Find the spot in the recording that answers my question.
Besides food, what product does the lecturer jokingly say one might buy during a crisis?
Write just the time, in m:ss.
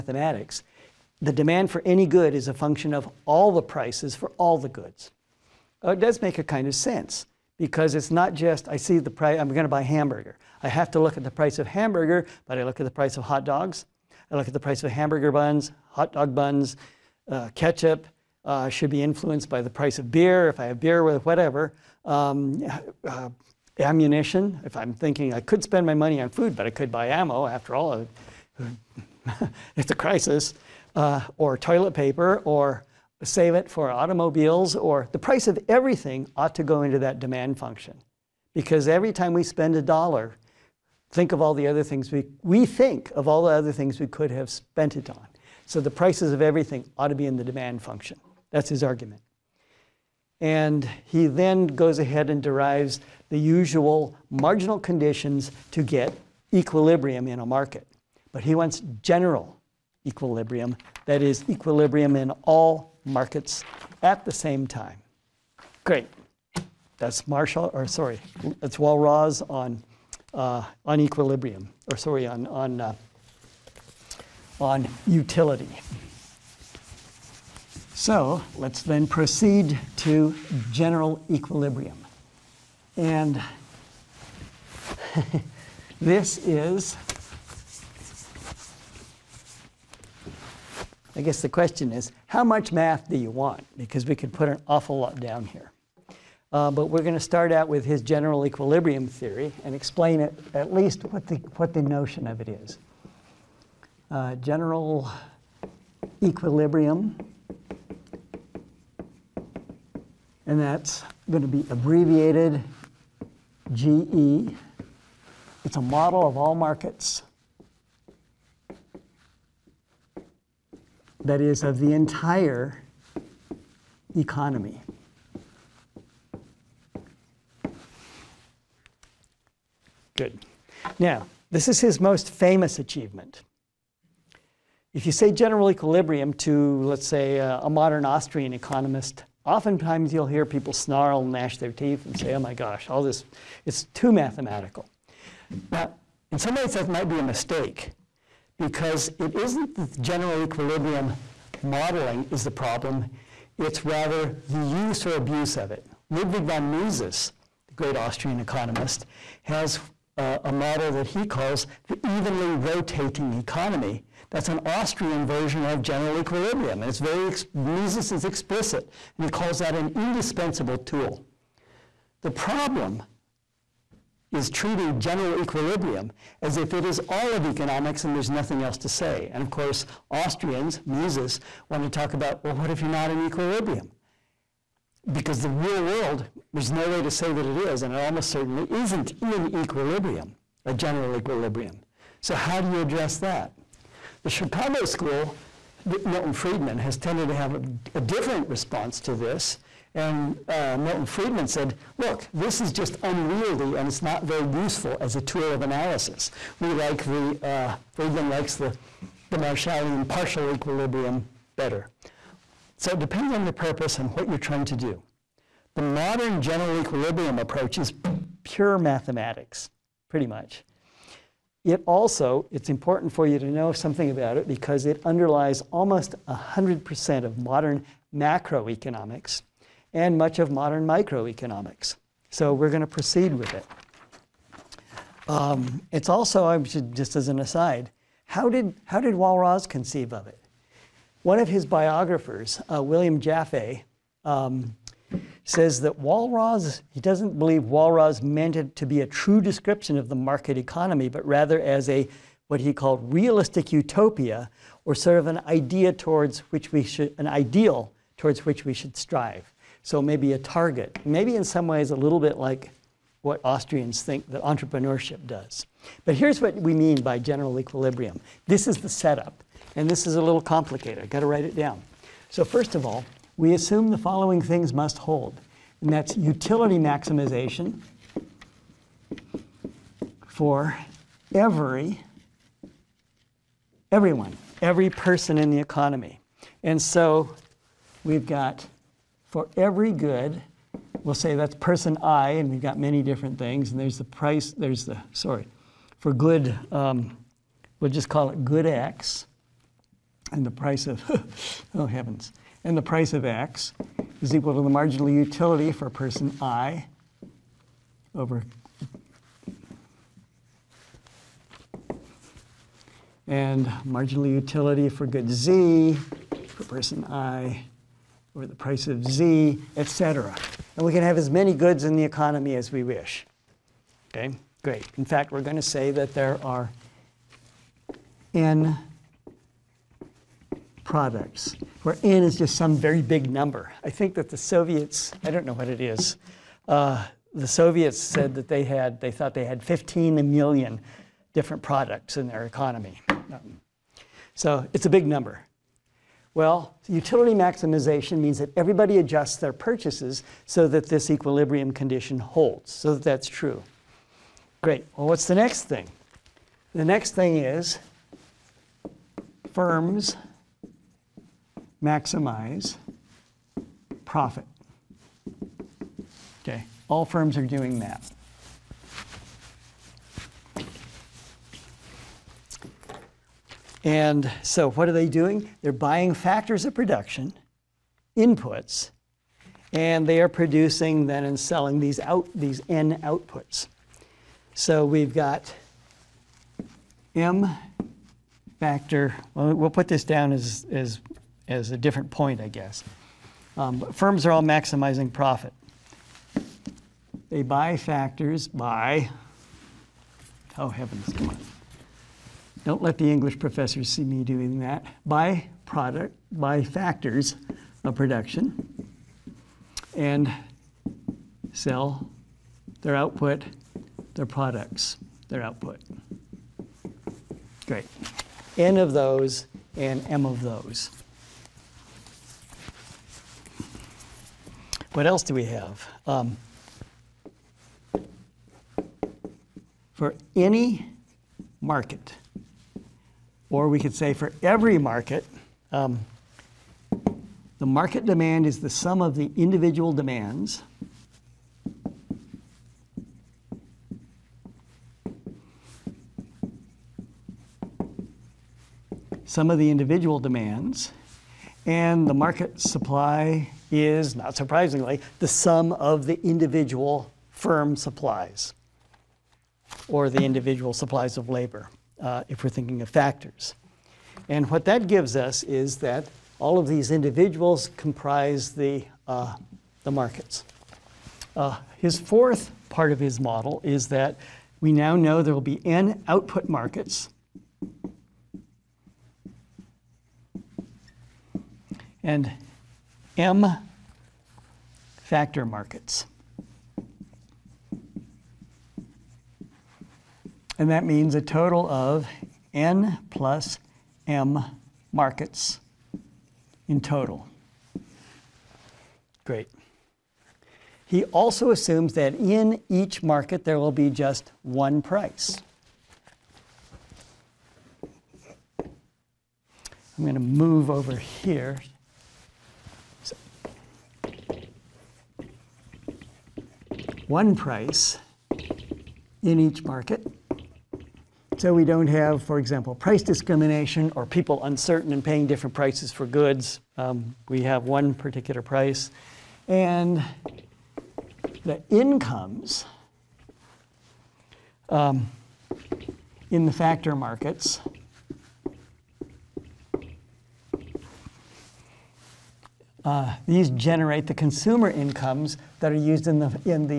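0:23.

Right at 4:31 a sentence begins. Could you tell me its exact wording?
I've got to write it down.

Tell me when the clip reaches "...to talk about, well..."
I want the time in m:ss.
3:01.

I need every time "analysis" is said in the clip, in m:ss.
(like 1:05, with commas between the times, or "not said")
3:25.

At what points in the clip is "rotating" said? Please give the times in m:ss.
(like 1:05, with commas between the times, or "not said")
2:42.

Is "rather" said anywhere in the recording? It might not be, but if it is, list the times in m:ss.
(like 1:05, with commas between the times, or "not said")
2:33, 4:11.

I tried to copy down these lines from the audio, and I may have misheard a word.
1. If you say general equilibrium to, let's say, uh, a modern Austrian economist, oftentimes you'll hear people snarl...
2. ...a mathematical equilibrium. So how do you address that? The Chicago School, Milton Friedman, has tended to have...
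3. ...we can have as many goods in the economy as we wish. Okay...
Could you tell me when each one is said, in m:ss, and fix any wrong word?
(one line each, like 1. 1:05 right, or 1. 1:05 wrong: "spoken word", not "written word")
1. 2:14 right
2. 3:10 wrong: "general", not "mathematical"
3. 5:20 right.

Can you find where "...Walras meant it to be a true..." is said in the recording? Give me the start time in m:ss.
4:07.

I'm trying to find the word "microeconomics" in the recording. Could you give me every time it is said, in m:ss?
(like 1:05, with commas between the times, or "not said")
3:50.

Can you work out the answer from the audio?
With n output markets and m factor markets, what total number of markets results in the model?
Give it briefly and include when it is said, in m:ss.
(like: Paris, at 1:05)
N plus M, at 8:12.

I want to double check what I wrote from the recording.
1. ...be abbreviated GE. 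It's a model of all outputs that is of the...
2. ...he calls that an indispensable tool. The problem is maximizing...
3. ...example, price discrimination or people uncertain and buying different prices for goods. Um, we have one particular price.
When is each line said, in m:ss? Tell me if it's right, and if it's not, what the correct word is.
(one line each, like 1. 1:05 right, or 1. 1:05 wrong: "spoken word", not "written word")
1. 1:51 wrong: "markets", not "outputs"
2. 2:49 wrong: "treating", not "maximizing"
3. 8:42 wrong: "paying", not "buying".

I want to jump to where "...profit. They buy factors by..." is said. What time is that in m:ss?
6:35.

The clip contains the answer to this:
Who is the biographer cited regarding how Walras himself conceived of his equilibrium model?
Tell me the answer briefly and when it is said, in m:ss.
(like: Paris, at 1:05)
William Jaffe, at 4:02.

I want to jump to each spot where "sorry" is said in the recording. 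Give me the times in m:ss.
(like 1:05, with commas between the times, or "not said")
1:07, 1:11, 4:55.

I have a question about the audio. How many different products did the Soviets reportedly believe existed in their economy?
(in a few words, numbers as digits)
15 million.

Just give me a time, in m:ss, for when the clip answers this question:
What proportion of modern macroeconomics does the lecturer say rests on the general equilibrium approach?
3:45.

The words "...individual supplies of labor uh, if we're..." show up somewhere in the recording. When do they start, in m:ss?
7:40.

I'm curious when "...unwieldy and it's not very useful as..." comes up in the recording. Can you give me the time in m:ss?
3:23.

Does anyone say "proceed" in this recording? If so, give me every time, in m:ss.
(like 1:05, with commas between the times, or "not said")
1:19, 3:52.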